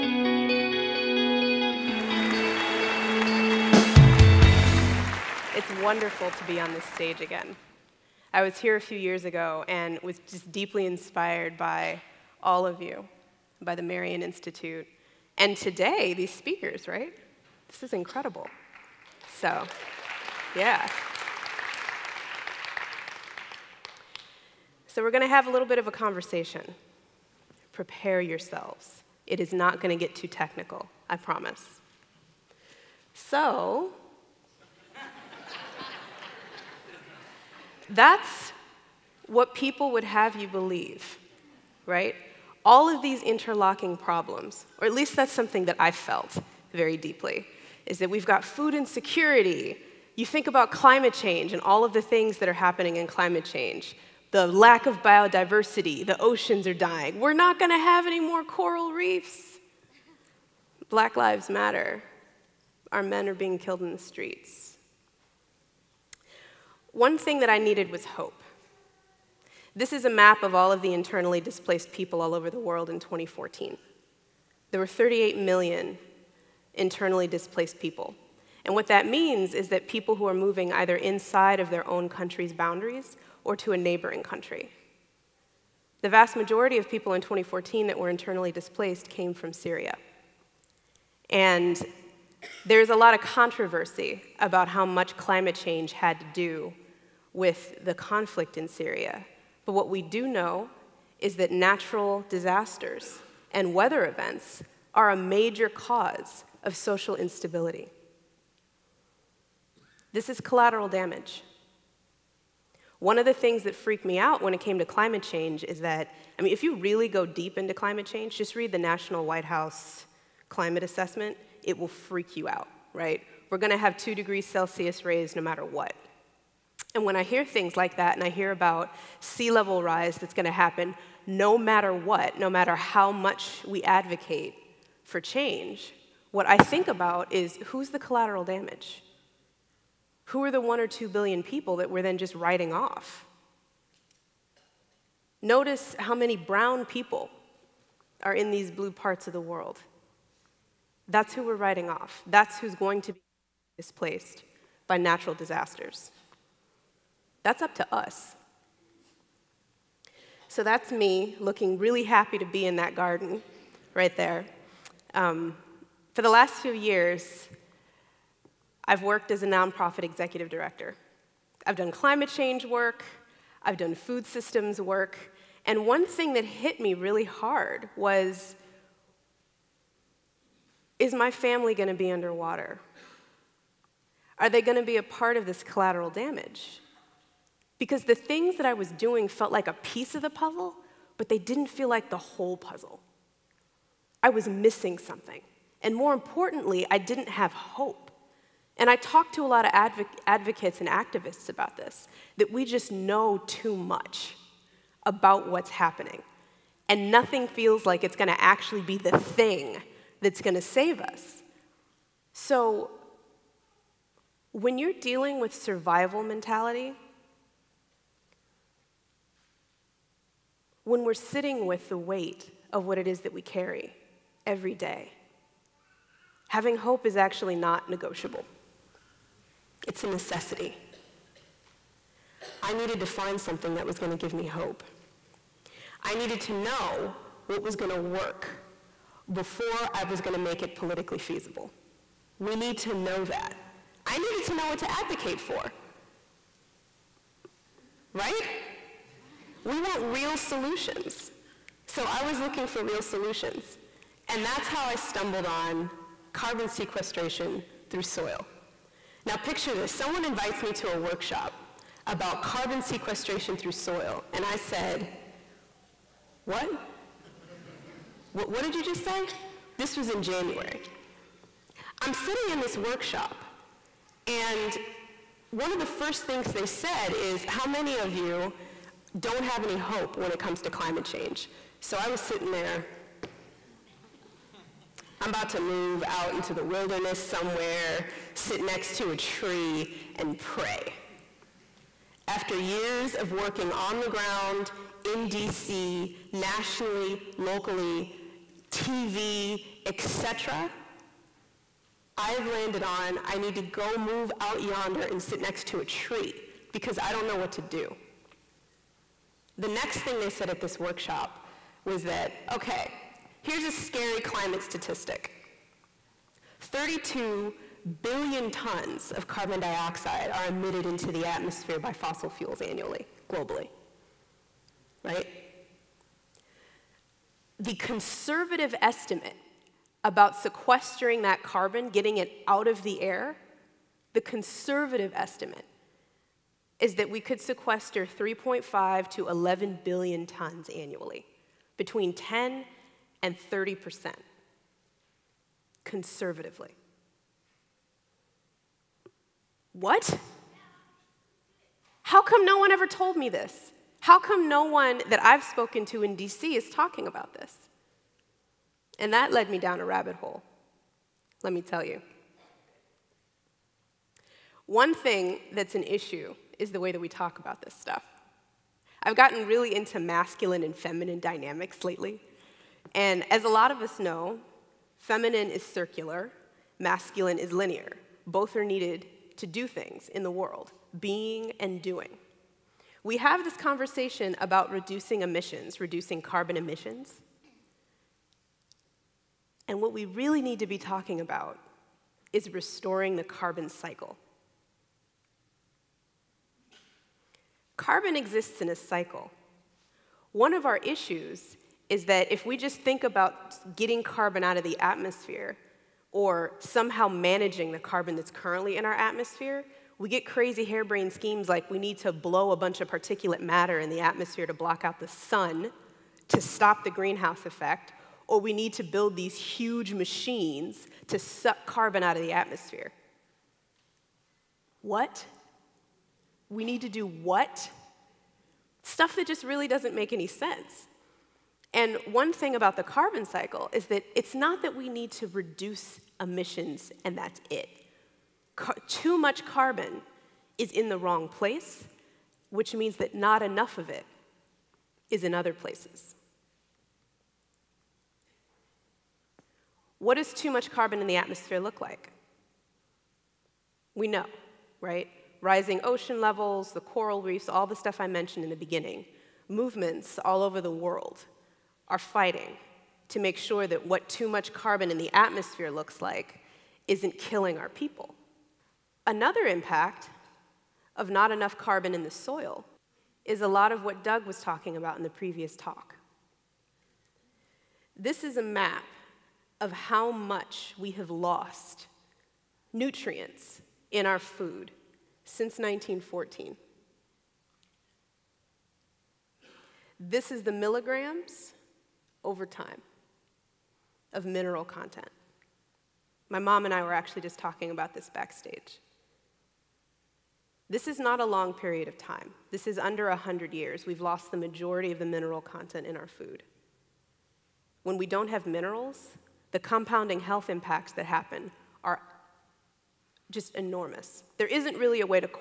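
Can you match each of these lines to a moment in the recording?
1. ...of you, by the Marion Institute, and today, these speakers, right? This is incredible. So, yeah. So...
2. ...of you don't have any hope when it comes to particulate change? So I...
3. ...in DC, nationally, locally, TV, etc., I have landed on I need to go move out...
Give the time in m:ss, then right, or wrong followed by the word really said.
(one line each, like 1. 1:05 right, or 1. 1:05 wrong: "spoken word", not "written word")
1. 0:12 right
2. 4:37 wrong: "climate", not "particulate"
3. 4:55 right.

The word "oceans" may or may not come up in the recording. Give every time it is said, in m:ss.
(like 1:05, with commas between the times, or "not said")
0:56, 7:35.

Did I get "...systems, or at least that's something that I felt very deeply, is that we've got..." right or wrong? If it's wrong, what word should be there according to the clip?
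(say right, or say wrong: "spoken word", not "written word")
wrong: "problems", not "systems".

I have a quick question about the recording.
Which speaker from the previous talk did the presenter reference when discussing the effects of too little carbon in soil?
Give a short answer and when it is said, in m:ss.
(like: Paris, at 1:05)
Doug, at 7:54.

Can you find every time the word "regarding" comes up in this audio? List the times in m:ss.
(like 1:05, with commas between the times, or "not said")
not said.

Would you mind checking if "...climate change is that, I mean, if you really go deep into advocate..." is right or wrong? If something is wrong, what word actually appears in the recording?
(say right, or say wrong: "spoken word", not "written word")
wrong: "climate", not "advocate".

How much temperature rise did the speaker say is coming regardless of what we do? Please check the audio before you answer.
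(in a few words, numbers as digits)
2 degrees Celsius.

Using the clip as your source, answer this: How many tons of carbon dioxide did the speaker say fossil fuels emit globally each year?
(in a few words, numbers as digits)
32 billion tons.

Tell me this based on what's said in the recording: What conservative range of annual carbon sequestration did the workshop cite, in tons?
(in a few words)
3.5 to 11 billion.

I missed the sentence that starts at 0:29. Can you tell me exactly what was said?
It is not going to get too technical, I promise.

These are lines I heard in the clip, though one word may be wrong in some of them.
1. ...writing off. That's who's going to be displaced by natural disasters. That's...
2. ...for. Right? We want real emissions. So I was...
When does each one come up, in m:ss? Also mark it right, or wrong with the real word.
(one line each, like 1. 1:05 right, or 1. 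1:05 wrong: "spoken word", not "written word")
1. 2:31 right
2. 4:05 wrong: "solutions", not "emissions".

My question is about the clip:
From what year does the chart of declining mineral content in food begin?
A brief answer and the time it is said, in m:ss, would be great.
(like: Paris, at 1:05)
1914, at 8:05.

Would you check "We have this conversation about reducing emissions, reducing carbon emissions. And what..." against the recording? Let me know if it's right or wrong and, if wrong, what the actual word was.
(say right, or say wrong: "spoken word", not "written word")
right.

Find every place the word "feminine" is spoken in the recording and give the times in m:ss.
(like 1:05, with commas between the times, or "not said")
6:10, 6:14.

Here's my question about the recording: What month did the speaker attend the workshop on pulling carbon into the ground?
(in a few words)
January.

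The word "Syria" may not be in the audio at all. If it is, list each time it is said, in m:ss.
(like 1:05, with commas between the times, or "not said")
1:29, 1:38.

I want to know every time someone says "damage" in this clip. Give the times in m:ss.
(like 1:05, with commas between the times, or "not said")
1:50, 2:18, 3:06.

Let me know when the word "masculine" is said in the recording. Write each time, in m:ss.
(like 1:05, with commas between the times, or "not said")
6:09, 6:16.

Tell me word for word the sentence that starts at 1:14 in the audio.
There were 38 million internally displaced people.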